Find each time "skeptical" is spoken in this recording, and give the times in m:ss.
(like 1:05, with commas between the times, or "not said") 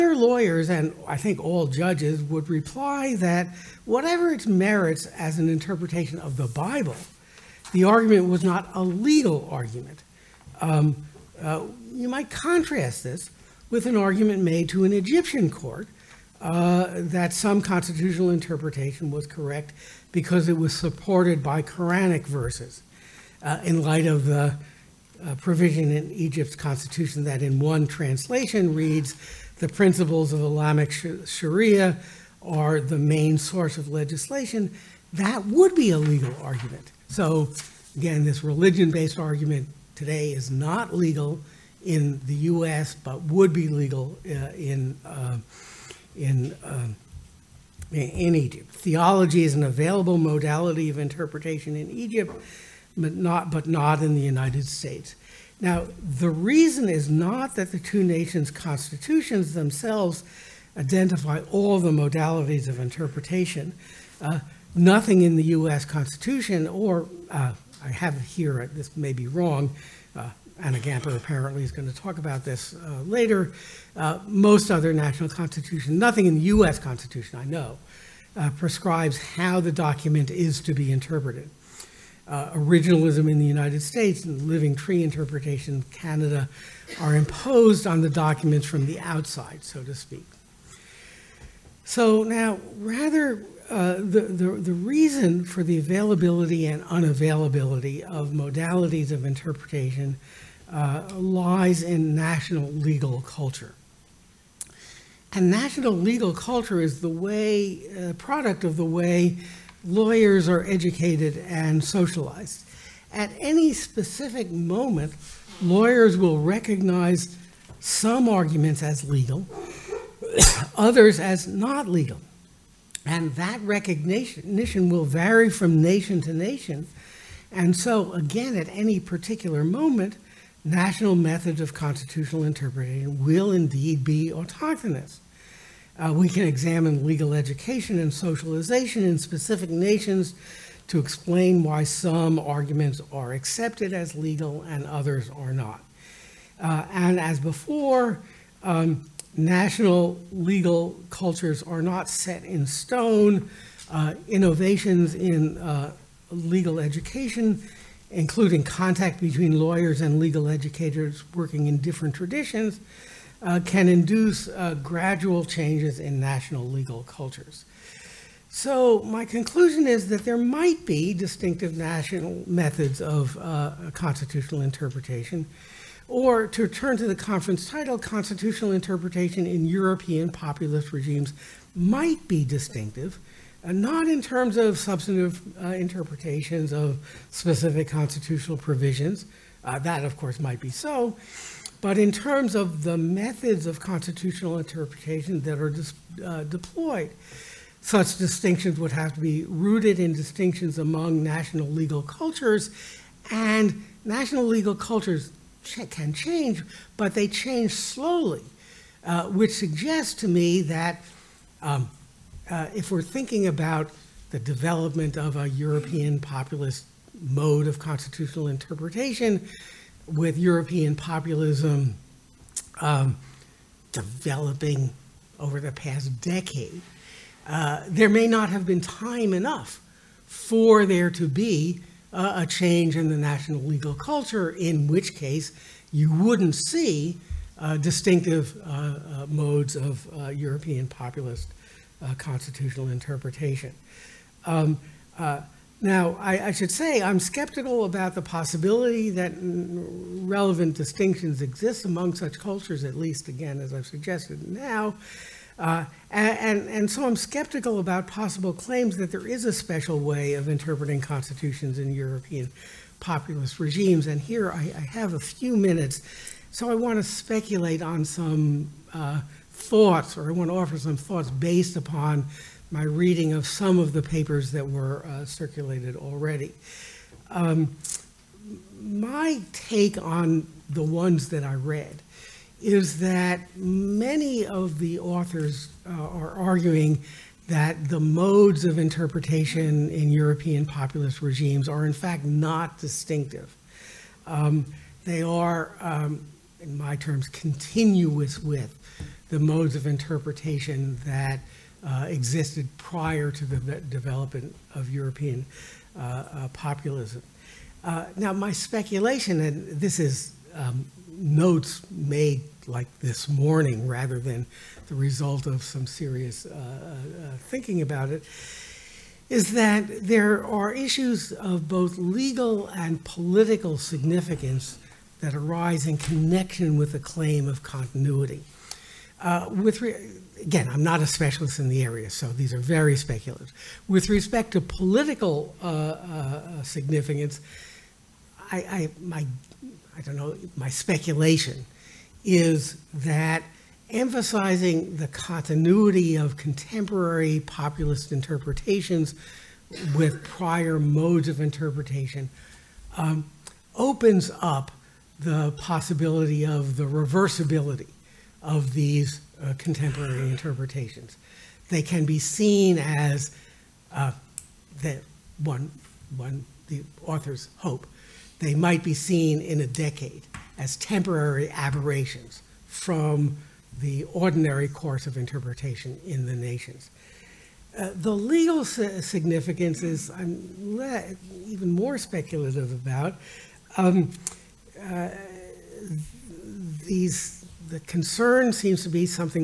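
4:07, 4:17.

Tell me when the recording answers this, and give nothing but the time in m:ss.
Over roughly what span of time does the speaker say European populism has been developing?
3:45.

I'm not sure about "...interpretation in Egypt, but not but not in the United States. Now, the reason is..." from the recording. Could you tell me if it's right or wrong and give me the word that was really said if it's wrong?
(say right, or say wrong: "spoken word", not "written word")
right.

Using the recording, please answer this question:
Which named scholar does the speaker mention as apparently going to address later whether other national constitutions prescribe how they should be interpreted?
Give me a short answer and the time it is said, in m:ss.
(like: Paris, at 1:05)
Anna Gamper, at 1:10.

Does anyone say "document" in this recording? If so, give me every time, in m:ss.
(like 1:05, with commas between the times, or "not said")
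1:19, 1:28.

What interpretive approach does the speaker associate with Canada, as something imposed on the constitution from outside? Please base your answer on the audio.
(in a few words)
Living tree interpretation.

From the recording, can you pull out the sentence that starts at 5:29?
Uh, with again, I'm not a specialist in the area, so these are very speculative.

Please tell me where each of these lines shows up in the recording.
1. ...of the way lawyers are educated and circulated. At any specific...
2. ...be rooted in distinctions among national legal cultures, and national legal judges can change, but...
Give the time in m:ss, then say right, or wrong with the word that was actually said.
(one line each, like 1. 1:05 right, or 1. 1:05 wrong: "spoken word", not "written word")
1. 1:48 wrong: "socialized", not "circulated"
2. 3:19 wrong: "cultures", not "judges".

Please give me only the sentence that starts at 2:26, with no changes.
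Uh, and as before, um, national legal cultures are not set in stone.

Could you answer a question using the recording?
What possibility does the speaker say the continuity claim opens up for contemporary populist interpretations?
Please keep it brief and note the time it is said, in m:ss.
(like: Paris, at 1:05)
Reversibility, at 5:56.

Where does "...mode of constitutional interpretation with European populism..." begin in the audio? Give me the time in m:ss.
3:37.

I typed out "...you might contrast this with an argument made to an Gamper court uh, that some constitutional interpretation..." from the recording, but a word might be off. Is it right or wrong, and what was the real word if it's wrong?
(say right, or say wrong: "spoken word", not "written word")
wrong: "Egyptian", not "Gamper".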